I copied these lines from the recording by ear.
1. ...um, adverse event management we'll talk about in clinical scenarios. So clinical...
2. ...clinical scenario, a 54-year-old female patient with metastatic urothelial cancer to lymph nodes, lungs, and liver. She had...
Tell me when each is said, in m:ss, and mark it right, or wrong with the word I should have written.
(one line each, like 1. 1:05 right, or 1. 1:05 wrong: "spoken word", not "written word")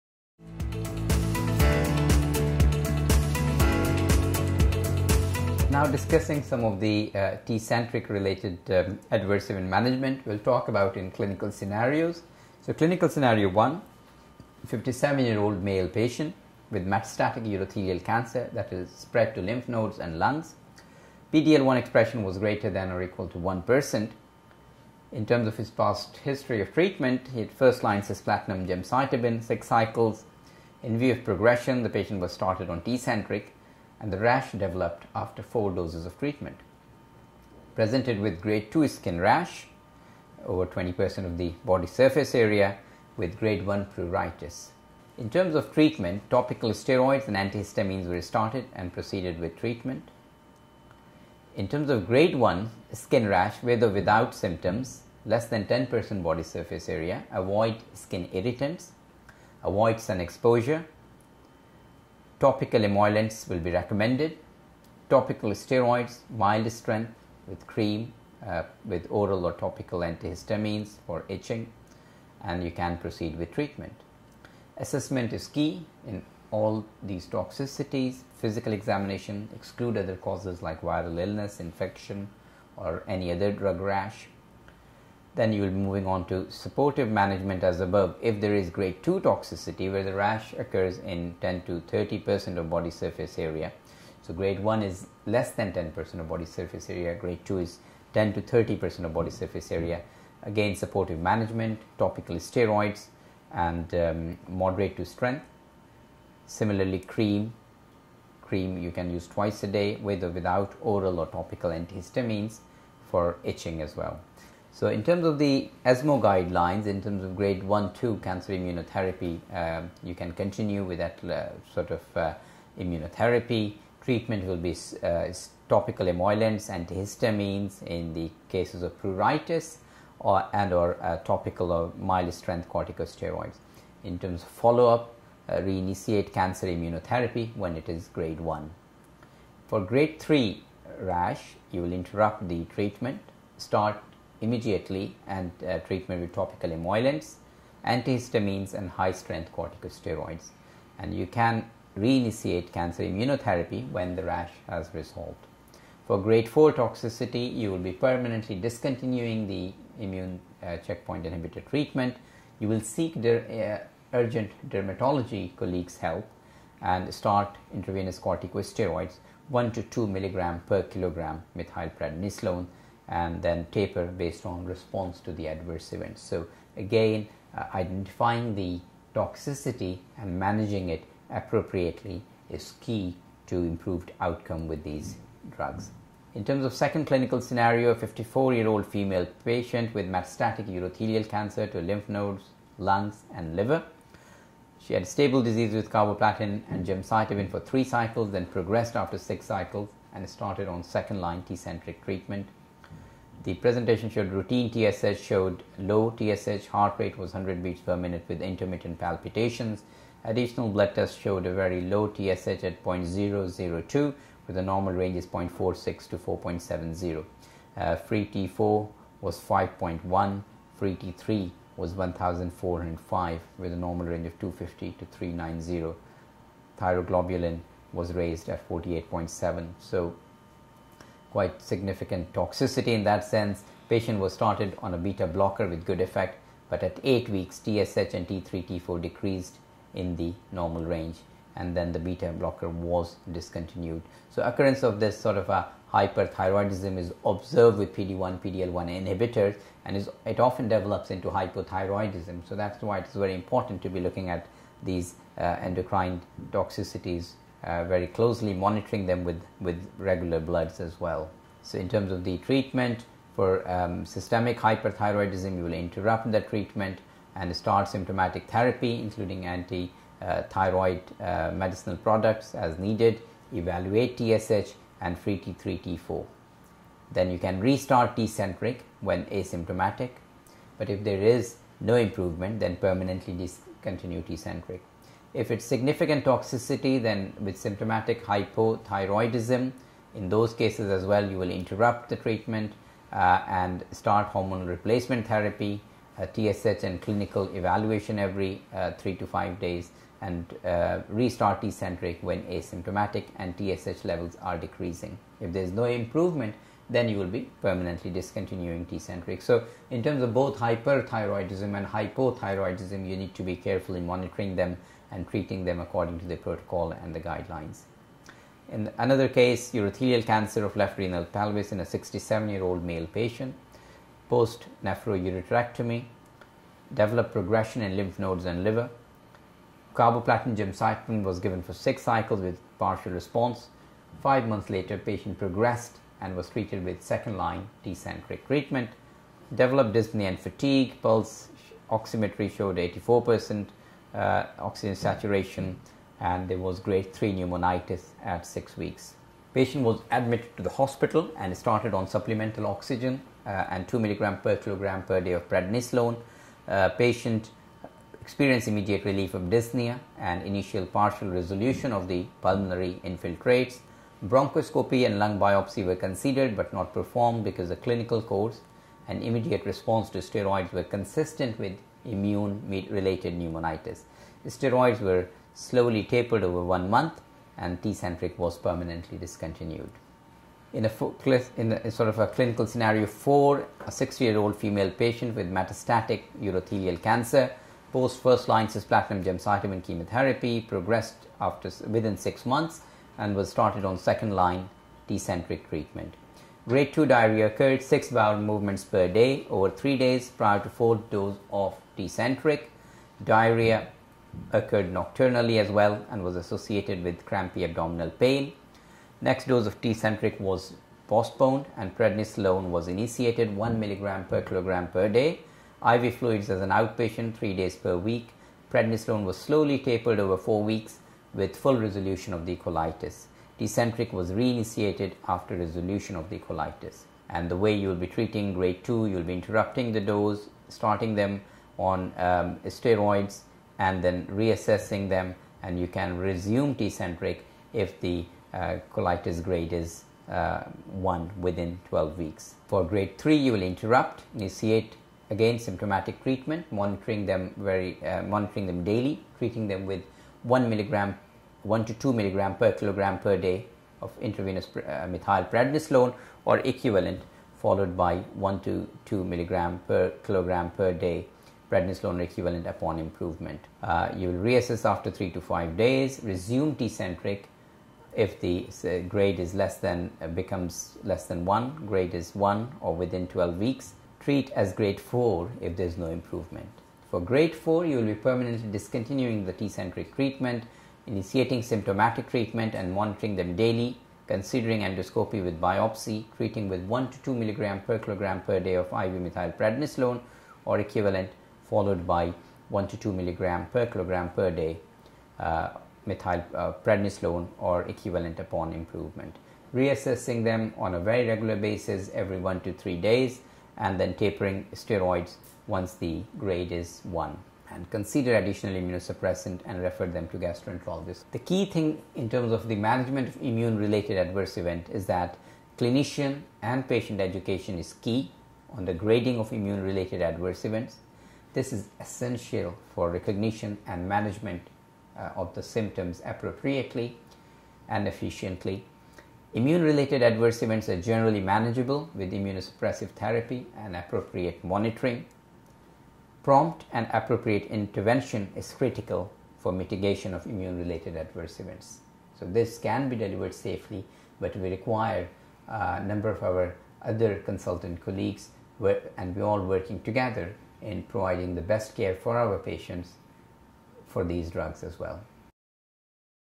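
1. 0:08 right
2. 3:07 right.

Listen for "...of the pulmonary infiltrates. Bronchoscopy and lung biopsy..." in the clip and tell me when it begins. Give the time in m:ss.
6:01.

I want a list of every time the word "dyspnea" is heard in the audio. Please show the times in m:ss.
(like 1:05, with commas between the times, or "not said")
5:39, 5:59.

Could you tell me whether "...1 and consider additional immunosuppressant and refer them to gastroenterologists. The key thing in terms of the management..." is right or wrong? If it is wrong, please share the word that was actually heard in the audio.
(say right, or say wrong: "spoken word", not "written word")
right.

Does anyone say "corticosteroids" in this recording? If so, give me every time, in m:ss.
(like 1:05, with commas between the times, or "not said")
2:12, 2:29, 2:48.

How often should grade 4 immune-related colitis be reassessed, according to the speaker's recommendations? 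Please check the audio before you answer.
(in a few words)
Every 1 to 3 days.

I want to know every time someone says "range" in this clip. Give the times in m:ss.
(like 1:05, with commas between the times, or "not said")
3:34, 3:44, 4:00.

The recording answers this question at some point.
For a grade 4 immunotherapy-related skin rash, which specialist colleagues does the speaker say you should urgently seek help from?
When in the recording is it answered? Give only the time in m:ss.
2:44.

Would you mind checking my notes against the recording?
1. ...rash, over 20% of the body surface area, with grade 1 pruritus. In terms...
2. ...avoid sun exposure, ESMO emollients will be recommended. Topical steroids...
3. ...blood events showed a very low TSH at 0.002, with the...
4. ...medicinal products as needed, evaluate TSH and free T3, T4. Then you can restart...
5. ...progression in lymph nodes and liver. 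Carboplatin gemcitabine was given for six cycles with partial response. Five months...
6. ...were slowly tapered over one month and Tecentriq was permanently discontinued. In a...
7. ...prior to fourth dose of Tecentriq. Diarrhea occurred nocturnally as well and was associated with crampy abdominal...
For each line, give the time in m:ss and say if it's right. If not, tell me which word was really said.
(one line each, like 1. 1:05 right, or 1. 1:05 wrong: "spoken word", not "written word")
1. 0:39 right
2. 0:59 wrong: "Topical", not "ESMO"
3. 3:30 wrong: "tests", not "events"
4. 4:31 right
5. 5:27 right
6. 6:15 right
7. 6:40 right.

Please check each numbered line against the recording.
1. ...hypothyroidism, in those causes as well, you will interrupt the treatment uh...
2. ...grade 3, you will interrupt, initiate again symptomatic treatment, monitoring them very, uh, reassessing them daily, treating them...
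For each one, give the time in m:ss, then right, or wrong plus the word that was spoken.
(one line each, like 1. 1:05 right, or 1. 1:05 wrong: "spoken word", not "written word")
1. 4:48 wrong: "cases", not "causes"
2. 7:22 wrong: "monitoring", not "reassessing".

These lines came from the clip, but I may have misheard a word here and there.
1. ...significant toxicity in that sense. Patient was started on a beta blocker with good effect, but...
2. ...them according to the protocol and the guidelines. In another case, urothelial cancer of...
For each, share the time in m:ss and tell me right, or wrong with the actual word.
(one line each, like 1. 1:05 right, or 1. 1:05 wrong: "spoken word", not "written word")
1. 3:51 right
2. 5:15 right.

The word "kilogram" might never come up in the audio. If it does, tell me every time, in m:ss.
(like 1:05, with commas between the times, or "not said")
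2:50, 5:54, 6:54, 7:32, 7:40, 8:07, 8:13.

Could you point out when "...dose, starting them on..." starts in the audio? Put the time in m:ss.
7:10.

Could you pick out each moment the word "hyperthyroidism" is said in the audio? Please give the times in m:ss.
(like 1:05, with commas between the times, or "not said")
4:05, 4:24, 5:10.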